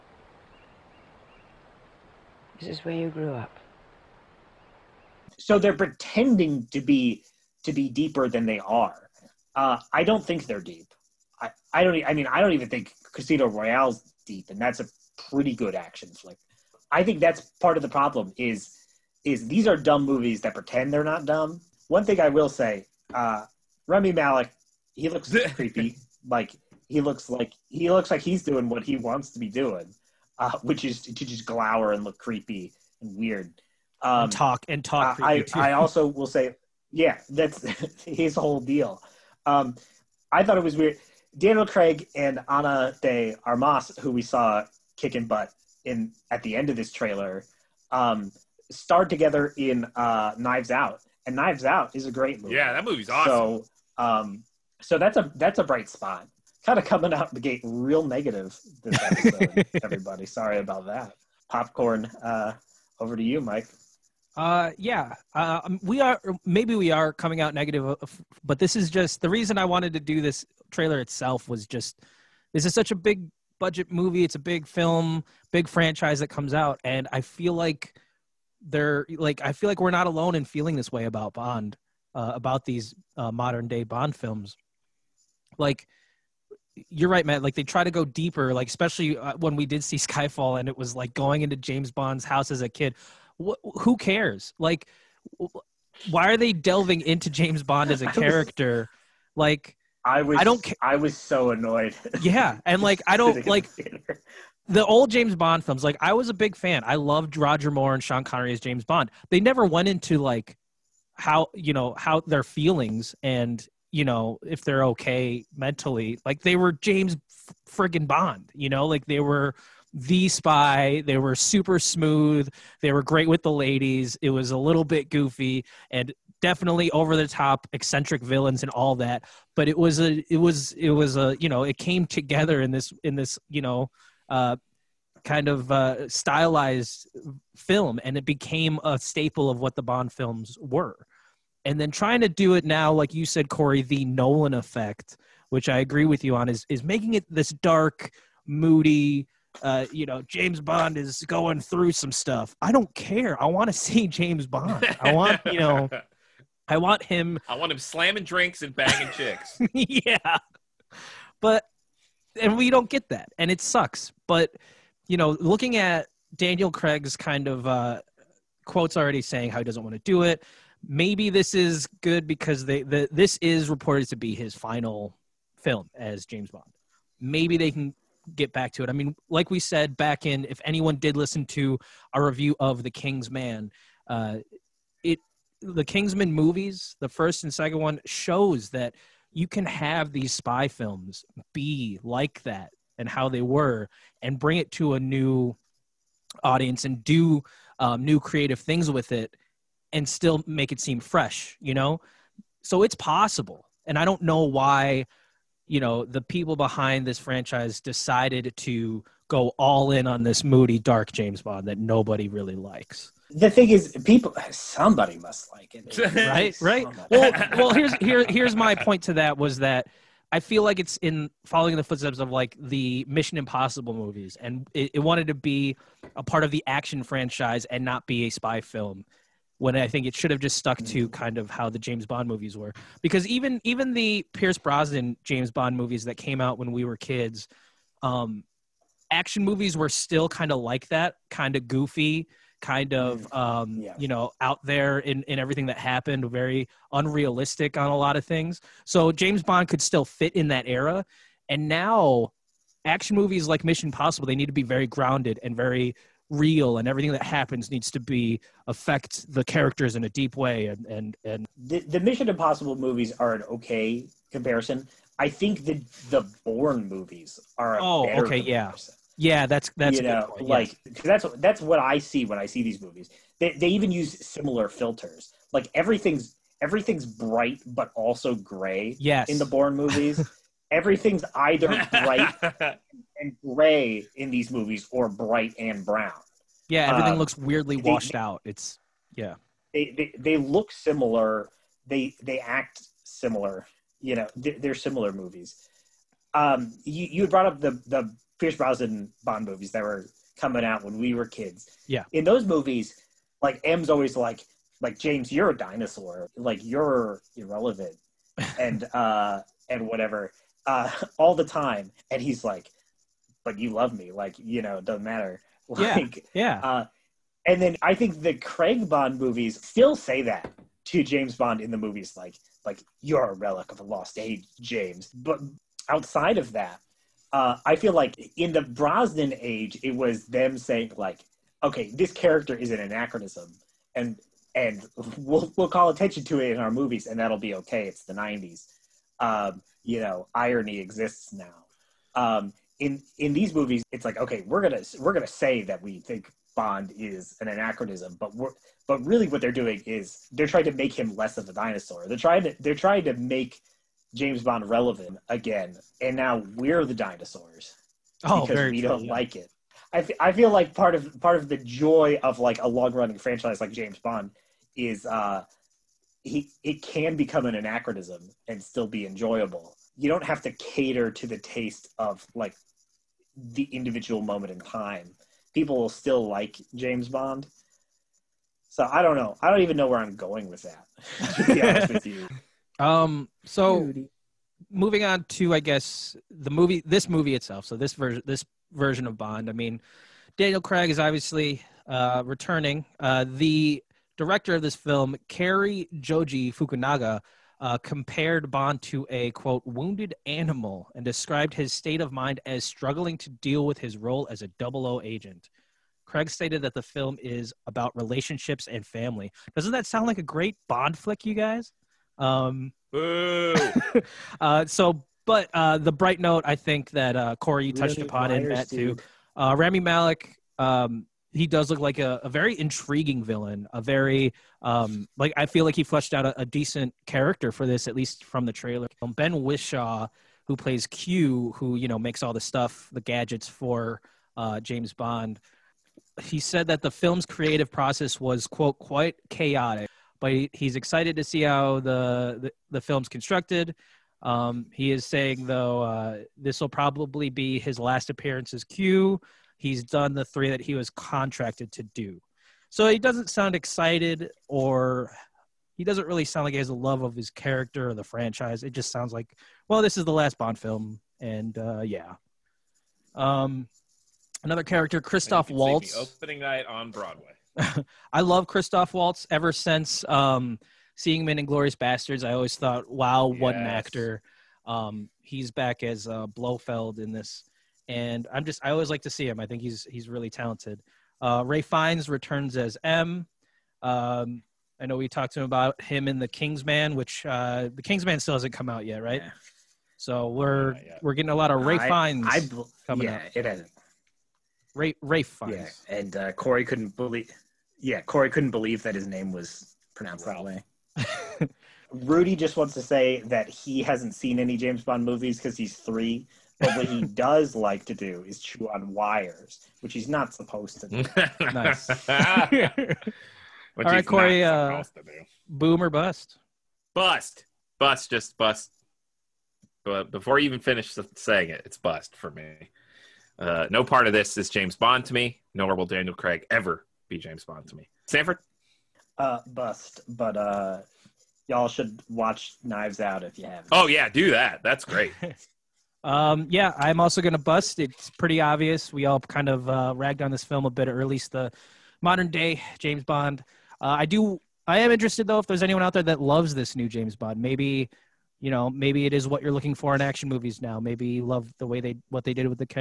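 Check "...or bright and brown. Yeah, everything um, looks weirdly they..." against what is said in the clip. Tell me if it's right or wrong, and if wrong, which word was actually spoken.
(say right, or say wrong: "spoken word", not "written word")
right.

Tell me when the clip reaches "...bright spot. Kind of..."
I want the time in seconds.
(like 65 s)
55 s.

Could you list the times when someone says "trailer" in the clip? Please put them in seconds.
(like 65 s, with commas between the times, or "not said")
46 s, 70 s, 428 s.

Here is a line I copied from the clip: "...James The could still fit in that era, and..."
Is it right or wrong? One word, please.
wrong.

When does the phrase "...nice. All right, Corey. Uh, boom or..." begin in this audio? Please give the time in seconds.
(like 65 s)
511 s.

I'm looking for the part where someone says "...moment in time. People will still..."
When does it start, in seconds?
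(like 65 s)
374 s.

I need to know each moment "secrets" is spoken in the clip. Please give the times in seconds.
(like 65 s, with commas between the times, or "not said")
not said.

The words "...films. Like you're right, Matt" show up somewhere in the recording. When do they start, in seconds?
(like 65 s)
84 s.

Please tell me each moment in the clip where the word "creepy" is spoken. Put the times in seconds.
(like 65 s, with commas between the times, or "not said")
25 s, 32 s.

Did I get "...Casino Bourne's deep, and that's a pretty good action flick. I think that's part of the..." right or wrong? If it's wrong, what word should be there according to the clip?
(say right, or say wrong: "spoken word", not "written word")
wrong: "Royale", not "Bourne".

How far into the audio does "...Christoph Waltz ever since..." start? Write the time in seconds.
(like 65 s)
468 s.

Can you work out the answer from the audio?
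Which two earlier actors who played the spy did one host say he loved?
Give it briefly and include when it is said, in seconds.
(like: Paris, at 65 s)
Roger Moore and Sean Connery, at 107 s.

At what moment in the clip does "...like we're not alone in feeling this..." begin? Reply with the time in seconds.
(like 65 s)
79 s.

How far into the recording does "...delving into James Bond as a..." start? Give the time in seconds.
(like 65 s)
96 s.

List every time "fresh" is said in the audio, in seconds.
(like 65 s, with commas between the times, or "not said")
200 s.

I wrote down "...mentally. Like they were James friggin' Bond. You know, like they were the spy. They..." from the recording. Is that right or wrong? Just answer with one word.
right.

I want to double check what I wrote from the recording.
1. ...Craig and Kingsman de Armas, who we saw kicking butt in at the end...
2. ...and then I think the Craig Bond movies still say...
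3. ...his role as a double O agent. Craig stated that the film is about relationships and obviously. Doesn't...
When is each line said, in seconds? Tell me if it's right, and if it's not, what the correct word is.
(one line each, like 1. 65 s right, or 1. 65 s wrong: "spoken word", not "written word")
1. 41 s wrong: "Ana", not "Kingsman"
2. 317 s right
3. 403 s wrong: "family", not "obviously".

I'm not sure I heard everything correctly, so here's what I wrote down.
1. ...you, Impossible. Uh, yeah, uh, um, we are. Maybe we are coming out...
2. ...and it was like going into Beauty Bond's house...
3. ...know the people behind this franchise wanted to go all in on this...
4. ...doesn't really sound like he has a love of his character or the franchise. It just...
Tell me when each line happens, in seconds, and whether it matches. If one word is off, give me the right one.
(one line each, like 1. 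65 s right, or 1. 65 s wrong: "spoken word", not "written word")
1. 63 s wrong: "Mike", not "Impossible"
2. 90 s wrong: "James", not "Beauty"
3. 205 s wrong: "decided", not "wanted"
4. 455 s right.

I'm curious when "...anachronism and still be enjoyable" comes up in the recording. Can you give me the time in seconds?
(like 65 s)
367 s.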